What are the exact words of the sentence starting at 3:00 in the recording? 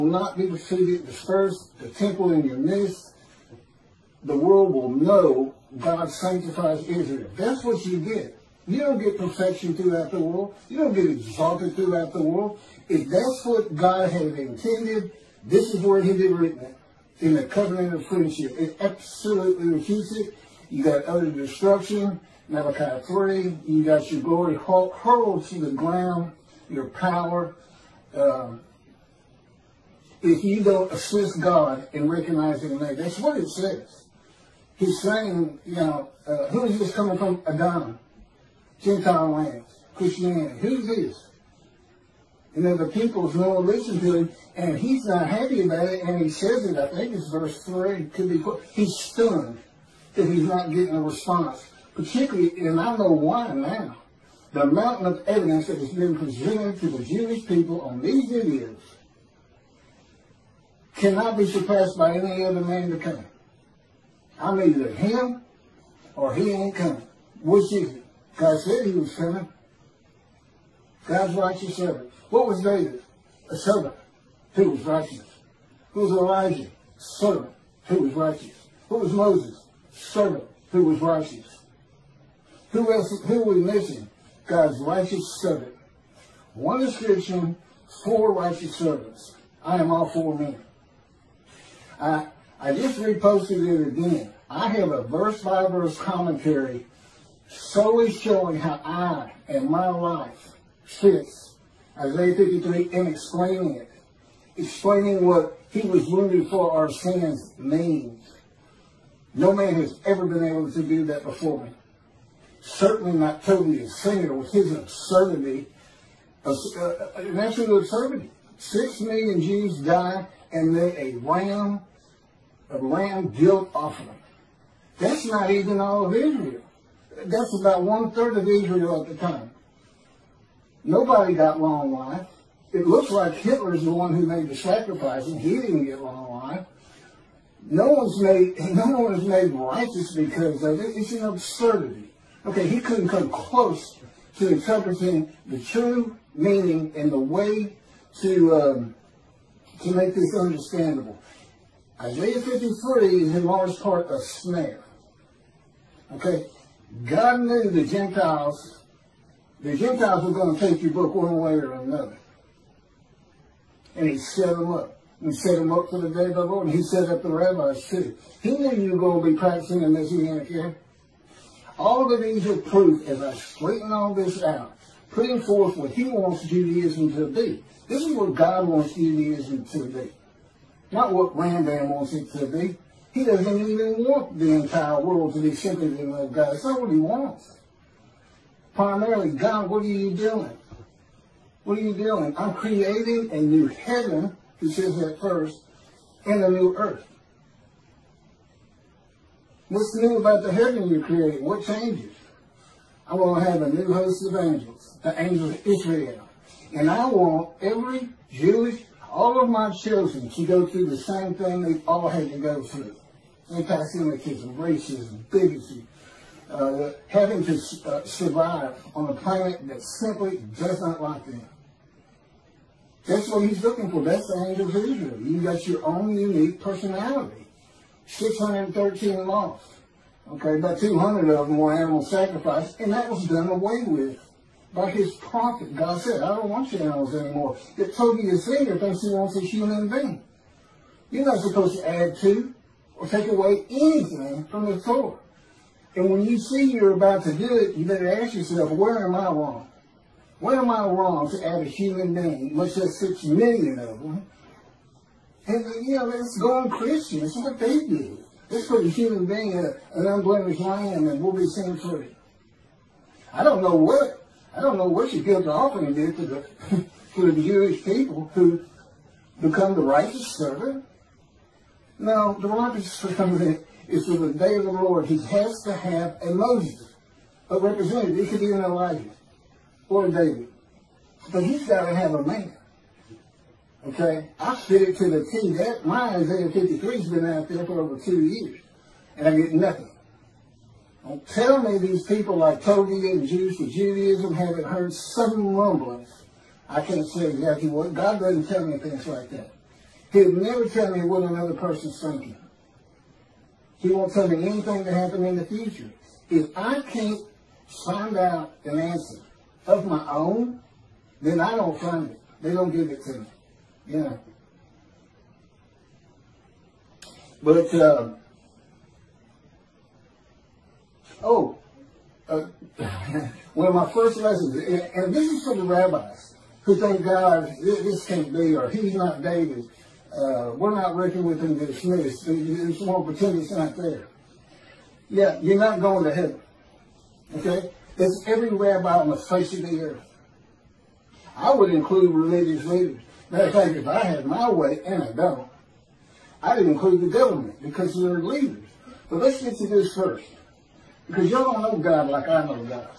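Not what Rambam wants it to be.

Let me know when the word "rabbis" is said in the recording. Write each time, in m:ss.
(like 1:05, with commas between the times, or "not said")
2:47, 5:25, 5:38.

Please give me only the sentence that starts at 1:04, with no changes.
I'm either him or he ain't coming.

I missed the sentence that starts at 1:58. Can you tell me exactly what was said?
Six million Jews die and made a ram, a ram guilt offering.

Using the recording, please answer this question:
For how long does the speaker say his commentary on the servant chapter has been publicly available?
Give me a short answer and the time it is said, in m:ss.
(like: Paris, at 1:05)
over two years, at 4:47.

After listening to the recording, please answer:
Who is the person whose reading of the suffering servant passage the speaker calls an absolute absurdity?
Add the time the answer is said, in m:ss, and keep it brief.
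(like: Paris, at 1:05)
Toby Singer, at 1:53.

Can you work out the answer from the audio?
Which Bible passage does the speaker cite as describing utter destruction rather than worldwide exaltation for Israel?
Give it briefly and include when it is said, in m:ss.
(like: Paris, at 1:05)
Malachi 3, at 0:22.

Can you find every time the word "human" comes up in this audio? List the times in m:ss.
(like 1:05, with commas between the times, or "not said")
3:59, 4:11, 4:18.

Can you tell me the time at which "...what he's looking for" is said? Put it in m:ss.
3:43.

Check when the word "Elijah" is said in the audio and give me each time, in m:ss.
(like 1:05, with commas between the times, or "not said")
1:16, 4:38.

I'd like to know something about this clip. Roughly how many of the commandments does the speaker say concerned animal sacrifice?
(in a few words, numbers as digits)
200.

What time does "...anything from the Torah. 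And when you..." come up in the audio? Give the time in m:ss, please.
4:03.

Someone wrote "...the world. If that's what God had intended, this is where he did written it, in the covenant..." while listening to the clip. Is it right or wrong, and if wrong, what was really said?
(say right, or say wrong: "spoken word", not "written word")
right.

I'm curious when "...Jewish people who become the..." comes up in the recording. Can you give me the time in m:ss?
4:27.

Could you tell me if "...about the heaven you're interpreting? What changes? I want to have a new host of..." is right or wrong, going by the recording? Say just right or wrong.
wrong.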